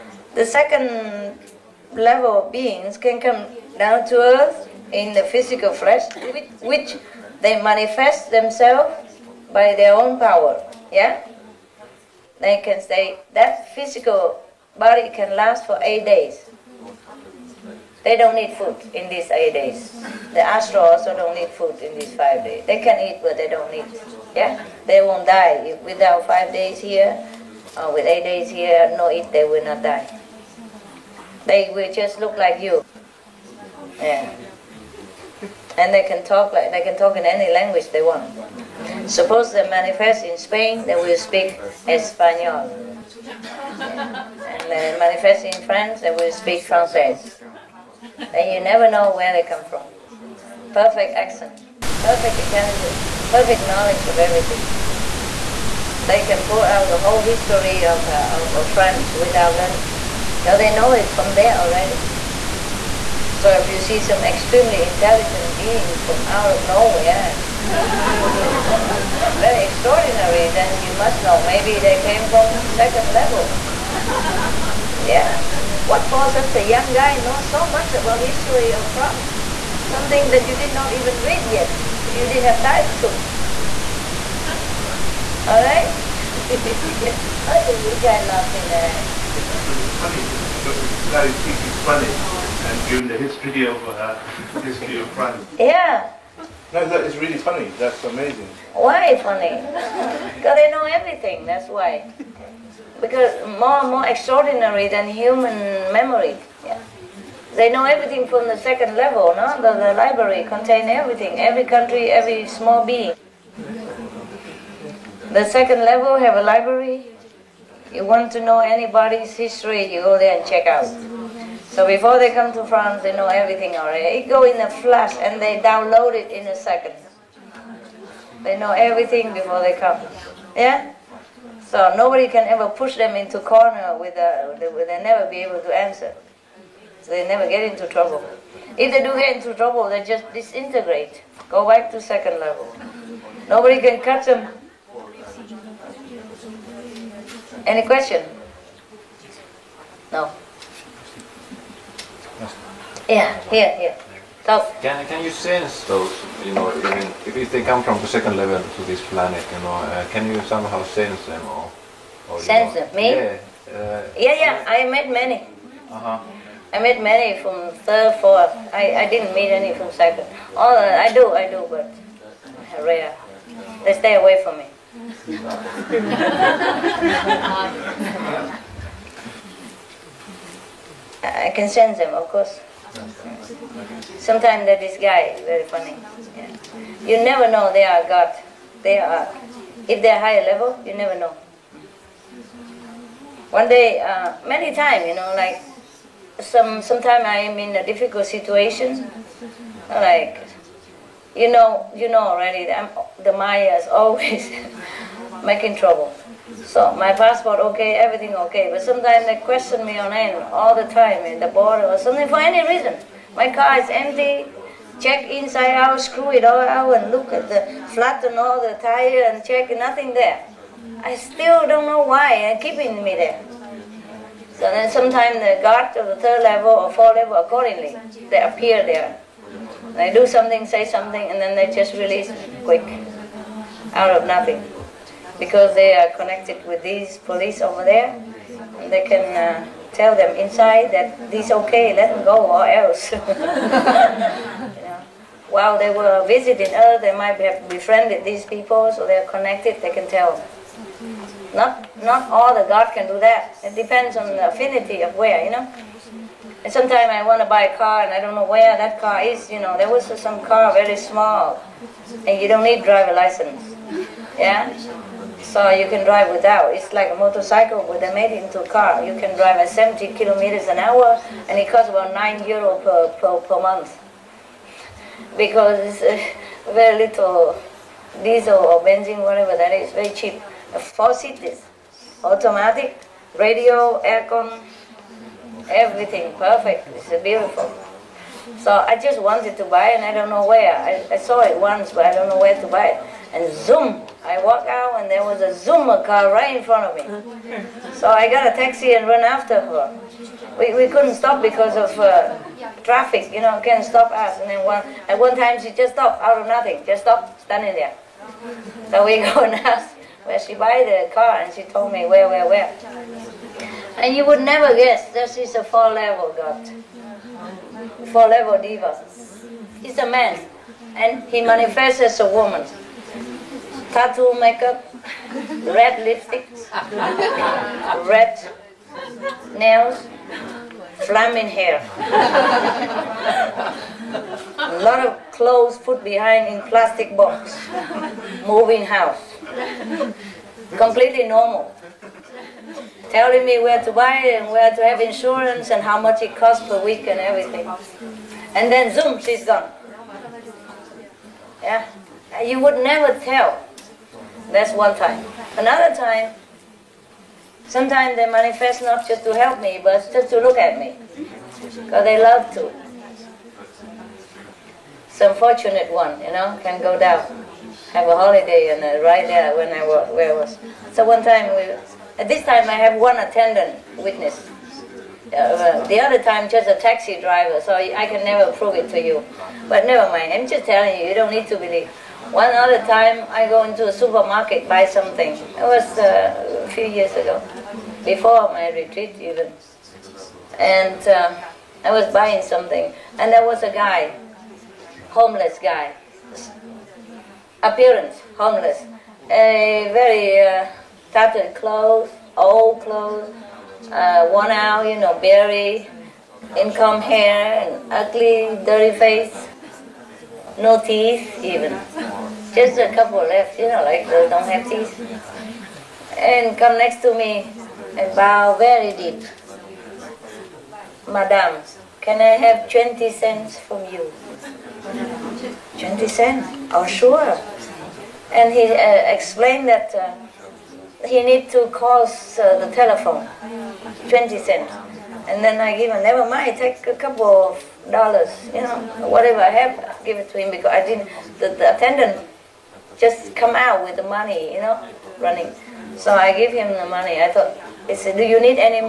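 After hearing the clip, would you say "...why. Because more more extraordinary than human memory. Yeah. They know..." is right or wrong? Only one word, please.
right.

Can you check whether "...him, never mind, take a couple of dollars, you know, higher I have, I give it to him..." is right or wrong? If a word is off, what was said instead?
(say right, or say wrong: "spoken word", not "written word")
wrong: "whatever", not "higher".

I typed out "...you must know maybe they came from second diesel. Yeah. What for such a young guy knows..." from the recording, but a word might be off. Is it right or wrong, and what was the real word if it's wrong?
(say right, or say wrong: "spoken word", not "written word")
wrong: "level", not "diesel".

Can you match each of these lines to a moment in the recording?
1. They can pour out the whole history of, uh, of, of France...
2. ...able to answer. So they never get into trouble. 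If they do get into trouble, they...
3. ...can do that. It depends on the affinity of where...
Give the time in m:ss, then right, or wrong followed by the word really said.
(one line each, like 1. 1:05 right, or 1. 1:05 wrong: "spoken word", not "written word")
1. 0:56 right
2. 2:15 right
3. 4:12 right.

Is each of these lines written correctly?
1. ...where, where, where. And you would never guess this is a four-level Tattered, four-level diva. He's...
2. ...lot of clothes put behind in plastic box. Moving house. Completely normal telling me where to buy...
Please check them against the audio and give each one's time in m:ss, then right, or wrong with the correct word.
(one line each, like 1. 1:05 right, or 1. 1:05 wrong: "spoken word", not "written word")
1. 5:12 wrong: "God", not "Tattered"
2. 5:34 right.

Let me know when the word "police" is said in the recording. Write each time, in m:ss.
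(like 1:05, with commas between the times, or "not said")
3:57.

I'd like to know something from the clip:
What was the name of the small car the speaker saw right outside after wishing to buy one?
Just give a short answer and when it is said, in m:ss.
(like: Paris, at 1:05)
Zoomer, at 4:55.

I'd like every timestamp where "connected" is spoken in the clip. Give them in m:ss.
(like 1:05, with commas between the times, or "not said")
3:56, 4:09.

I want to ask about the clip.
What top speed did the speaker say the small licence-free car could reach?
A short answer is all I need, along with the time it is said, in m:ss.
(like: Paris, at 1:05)
70 kilometers an hour, at 4:29.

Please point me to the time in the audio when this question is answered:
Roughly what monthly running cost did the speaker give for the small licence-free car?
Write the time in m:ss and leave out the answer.
4:32.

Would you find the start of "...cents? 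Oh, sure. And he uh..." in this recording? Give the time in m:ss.
7:06.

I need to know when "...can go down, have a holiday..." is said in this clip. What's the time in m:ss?
6:06.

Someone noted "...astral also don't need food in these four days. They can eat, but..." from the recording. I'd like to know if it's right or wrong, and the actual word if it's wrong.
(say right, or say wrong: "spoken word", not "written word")
wrong: "five", not "four".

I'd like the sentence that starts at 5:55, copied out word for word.
Another time, sometimes they manifest not just to help me, but just to look at me, because they love to.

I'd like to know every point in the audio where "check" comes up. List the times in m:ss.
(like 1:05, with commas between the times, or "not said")
2:00, 3:34, 3:39.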